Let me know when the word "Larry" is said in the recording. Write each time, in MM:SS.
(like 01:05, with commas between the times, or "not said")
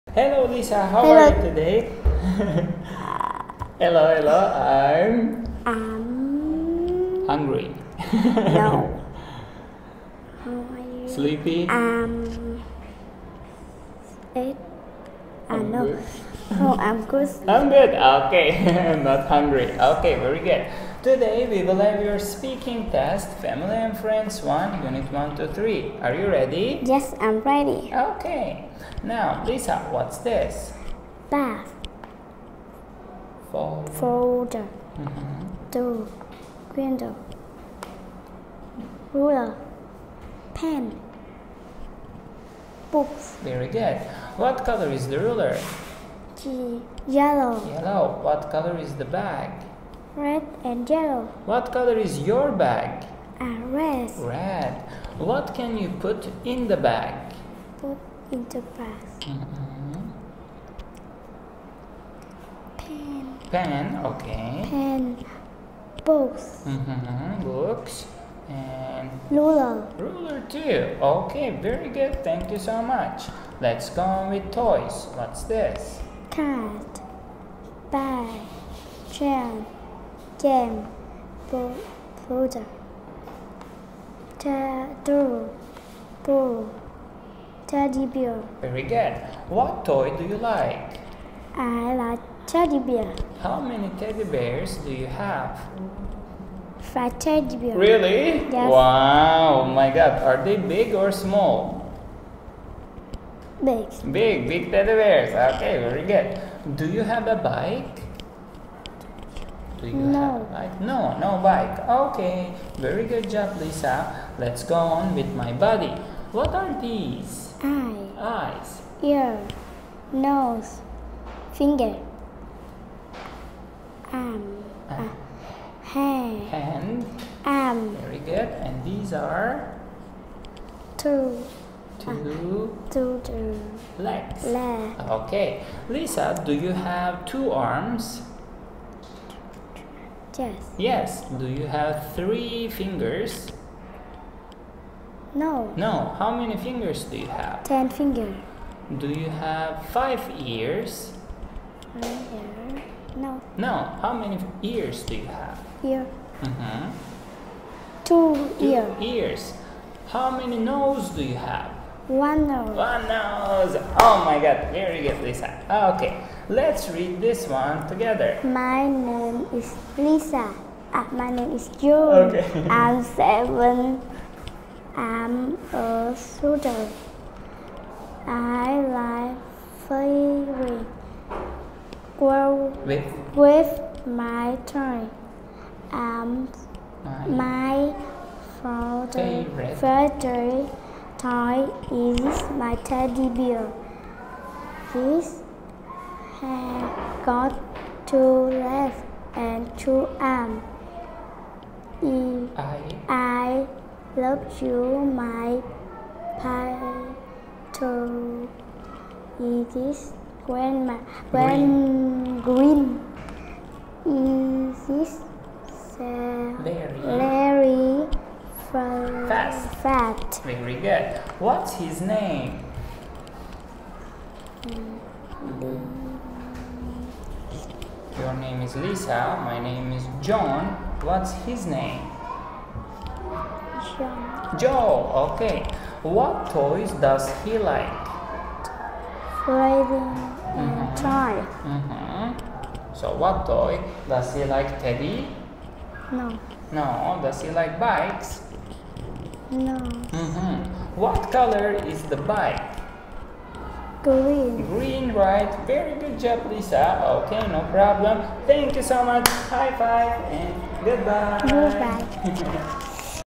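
03:36.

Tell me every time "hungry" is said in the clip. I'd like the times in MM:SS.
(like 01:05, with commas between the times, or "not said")
00:07, 00:19.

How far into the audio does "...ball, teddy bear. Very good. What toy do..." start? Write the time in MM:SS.
01:26.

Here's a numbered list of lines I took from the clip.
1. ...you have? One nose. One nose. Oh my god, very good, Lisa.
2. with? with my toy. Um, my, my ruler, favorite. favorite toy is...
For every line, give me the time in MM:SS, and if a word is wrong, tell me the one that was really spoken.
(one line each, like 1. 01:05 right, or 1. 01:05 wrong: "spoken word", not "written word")
1. 02:41 right
2. 03:02 wrong: "father", not "ruler".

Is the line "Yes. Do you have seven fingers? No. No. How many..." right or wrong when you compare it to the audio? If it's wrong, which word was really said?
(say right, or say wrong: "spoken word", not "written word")
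wrong: "three", not "seven".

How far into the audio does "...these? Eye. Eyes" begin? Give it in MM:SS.
01:56.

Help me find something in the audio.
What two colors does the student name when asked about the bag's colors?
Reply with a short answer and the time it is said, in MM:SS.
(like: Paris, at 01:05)
Red and yellow, at 00:50.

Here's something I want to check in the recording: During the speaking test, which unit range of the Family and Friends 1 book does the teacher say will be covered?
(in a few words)
Unit 1 to 3.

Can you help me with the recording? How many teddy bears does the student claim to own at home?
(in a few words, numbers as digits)
5.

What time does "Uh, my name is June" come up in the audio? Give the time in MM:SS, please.
02:50.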